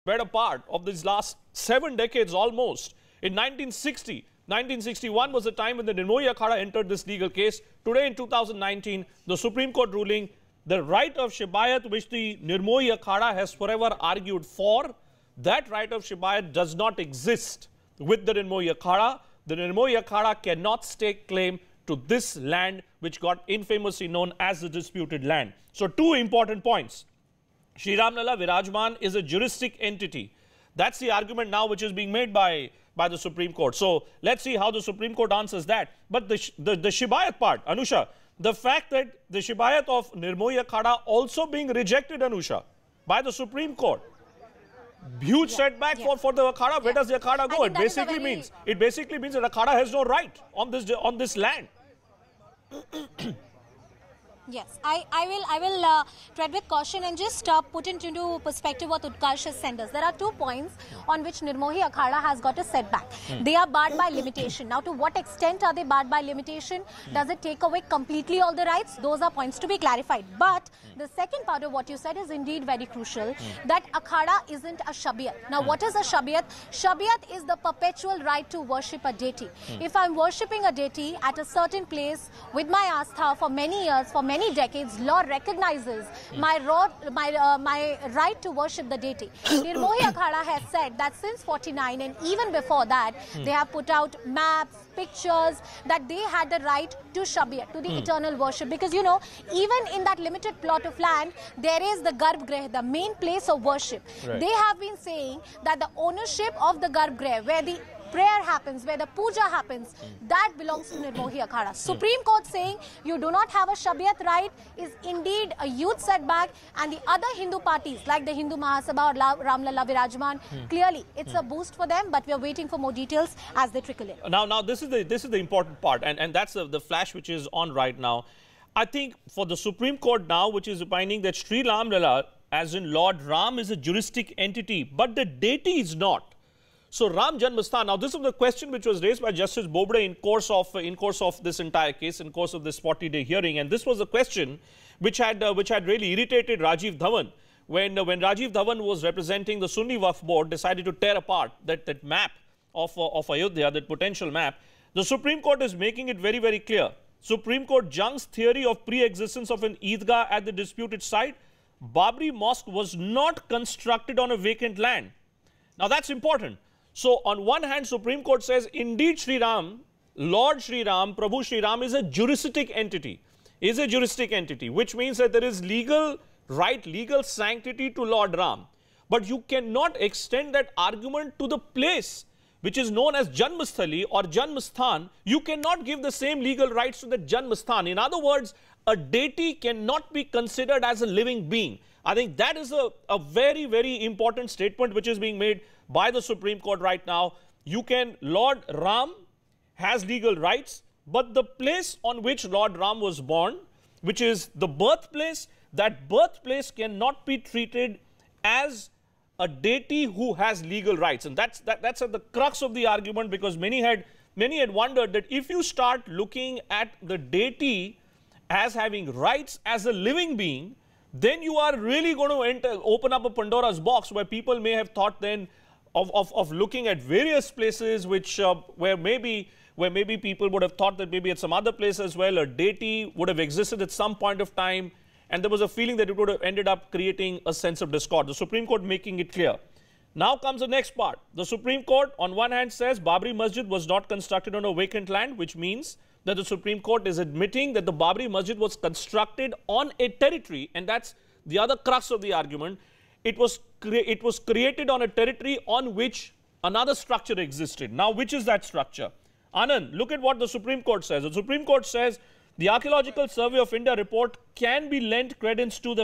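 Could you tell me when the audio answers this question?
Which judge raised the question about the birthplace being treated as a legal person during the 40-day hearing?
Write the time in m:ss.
2:19.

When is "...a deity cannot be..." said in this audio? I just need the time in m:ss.
3:08.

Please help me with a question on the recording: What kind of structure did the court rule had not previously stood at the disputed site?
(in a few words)
Eidgah.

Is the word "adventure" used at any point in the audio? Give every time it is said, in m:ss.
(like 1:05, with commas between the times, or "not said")
not said.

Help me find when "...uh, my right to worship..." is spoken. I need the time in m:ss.
1:27.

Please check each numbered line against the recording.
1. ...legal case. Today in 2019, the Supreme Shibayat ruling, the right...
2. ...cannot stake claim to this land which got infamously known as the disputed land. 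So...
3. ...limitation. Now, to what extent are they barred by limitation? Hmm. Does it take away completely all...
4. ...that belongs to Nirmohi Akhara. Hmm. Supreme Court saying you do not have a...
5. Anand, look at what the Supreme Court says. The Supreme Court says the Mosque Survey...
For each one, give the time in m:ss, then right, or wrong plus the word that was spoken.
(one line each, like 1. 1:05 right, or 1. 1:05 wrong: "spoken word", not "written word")
1. 0:07 wrong: "Court", not "Shibayat"
2. 0:20 right
3. 1:04 right
4. 1:50 right
5. 4:19 wrong: "Archaeological", not "Mosque".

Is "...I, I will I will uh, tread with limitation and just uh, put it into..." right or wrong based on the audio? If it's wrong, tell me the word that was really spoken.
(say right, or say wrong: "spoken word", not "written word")
wrong: "caution", not "limitation".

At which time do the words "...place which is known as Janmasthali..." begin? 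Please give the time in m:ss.
3:01.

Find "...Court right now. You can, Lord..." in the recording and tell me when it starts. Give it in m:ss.
3:16.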